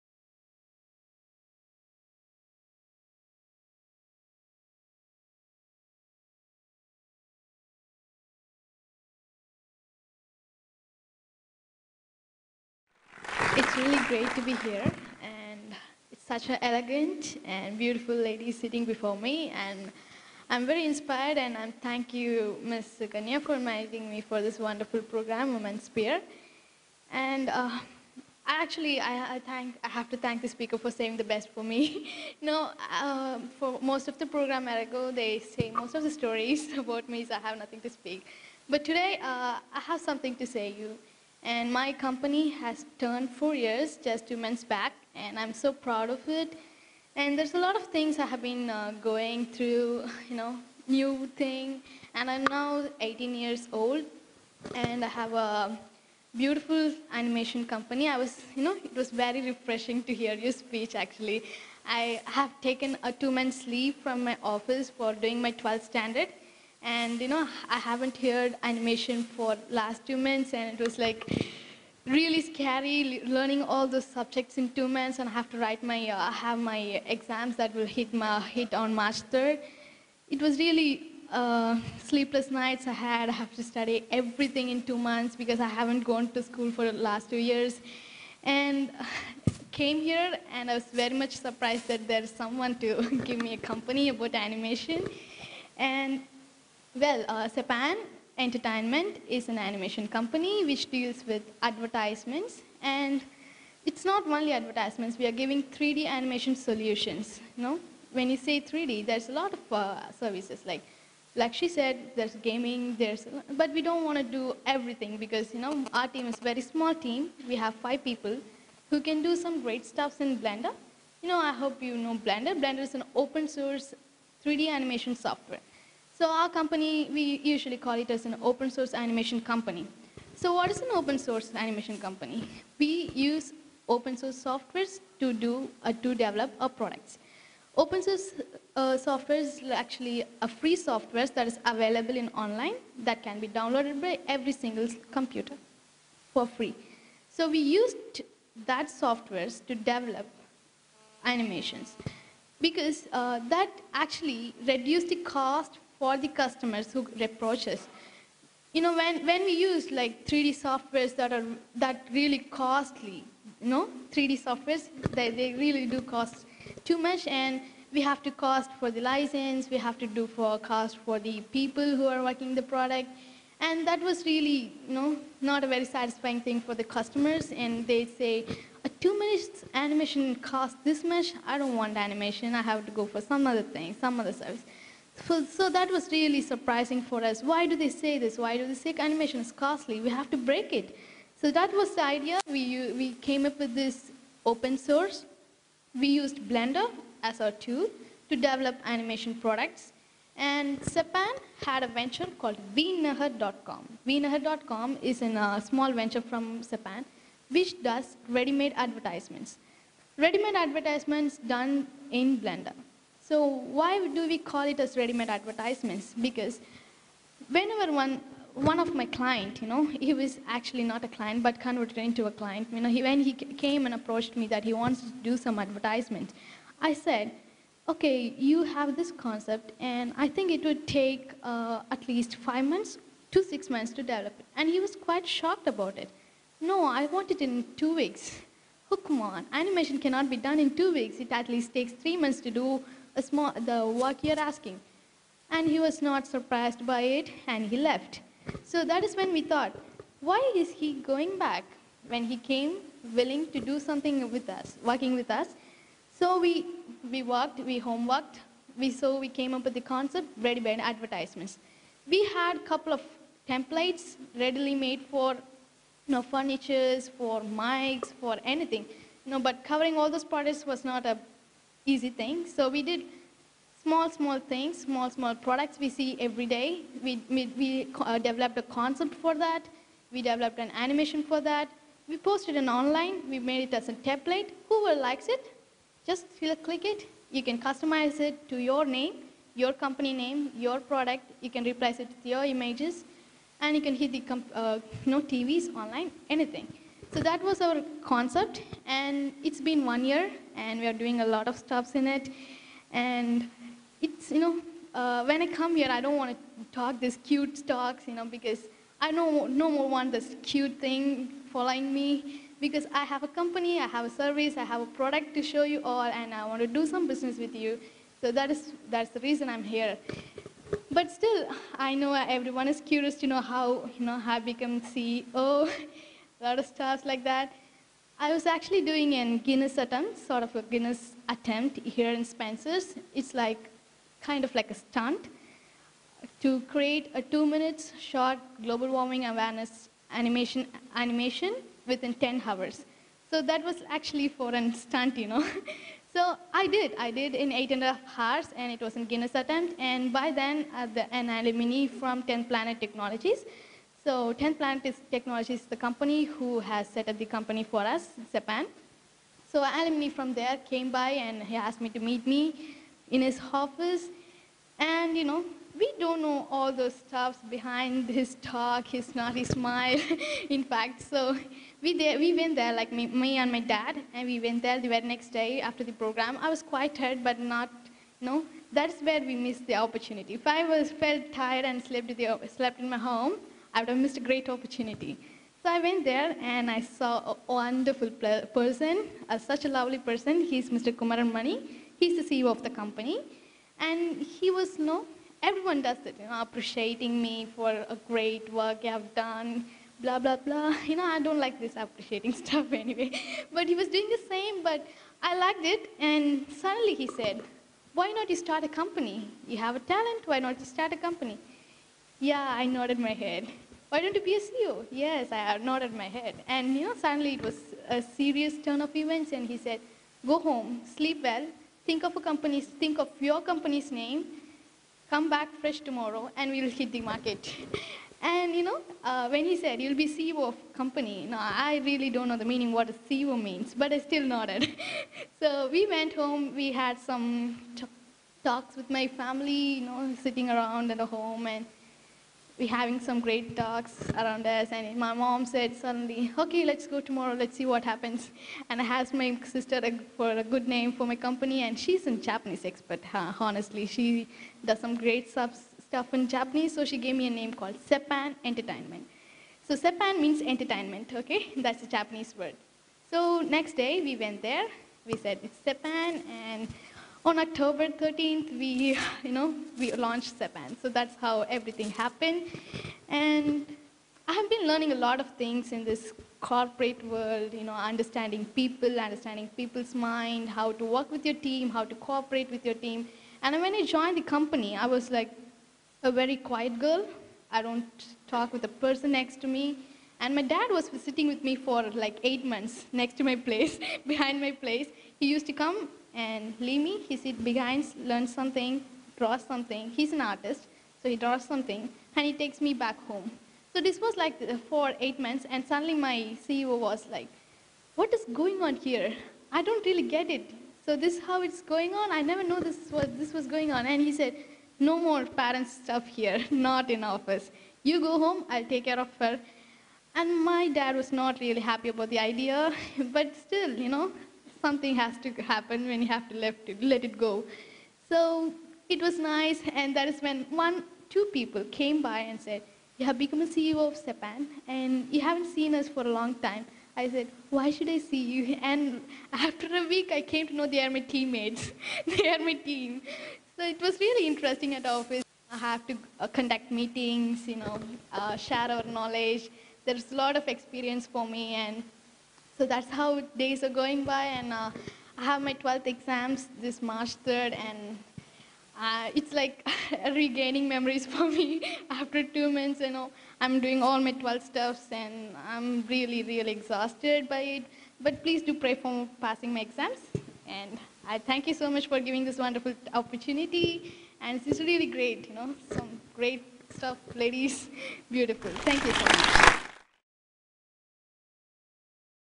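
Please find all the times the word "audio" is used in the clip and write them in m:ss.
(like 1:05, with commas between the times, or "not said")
not said.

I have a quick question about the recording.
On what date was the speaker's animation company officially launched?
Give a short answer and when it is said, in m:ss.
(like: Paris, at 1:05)
October 13th, at 7:47.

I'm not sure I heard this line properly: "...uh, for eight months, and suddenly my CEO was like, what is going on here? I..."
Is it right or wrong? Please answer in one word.
right.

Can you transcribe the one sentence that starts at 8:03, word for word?
And when I joined the company, I was like a very quiet girl.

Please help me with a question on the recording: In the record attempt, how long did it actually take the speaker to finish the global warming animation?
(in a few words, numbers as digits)
8.5 hours.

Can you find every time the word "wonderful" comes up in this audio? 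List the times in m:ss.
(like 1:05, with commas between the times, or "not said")
0:24, 6:27, 9:32.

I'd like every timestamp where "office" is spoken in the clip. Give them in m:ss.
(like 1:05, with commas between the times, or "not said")
1:04, 6:03, 8:37, 9:04.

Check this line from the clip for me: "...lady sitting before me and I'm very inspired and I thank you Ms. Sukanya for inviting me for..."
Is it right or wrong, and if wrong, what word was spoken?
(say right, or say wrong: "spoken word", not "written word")
right.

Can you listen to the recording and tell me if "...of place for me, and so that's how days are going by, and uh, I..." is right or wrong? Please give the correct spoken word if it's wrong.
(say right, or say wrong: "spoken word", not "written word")
wrong: "experience", not "place".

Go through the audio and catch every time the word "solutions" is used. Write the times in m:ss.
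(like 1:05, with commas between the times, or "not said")
1:46.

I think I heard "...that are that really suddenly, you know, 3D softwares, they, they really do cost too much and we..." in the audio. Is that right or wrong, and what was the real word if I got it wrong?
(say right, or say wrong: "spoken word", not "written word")
wrong: "costly", not "suddenly".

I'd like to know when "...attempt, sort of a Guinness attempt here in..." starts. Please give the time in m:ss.
5:29.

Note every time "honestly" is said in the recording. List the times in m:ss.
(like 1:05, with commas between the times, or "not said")
7:33.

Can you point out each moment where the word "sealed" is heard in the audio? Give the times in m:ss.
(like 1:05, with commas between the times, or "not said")
not said.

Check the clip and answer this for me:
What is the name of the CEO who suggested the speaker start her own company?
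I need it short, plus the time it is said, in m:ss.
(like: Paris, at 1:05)
Kumaran Mani, at 6:30.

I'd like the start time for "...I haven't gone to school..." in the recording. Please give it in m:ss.
1:25.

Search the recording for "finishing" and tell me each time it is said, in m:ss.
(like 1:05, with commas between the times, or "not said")
not said.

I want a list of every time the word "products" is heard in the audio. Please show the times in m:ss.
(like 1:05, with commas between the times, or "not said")
2:16, 2:52, 3:19, 4:30, 4:35, 4:50, 5:14.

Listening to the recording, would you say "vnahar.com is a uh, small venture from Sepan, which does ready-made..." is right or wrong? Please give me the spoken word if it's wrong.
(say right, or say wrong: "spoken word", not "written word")
right.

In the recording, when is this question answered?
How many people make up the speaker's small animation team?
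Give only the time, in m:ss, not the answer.
1:57.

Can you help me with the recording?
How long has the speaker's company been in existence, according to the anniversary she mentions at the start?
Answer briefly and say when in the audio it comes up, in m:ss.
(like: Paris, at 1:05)
4 years, at 0:43.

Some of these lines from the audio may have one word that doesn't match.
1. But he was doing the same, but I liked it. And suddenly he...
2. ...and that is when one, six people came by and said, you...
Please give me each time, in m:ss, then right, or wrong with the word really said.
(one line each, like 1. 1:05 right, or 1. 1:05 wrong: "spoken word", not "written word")
1. 6:43 right
2. 8:49 wrong: "two", not "six".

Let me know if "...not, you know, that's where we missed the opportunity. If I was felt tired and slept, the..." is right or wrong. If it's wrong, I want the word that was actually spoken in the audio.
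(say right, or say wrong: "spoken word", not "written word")
right.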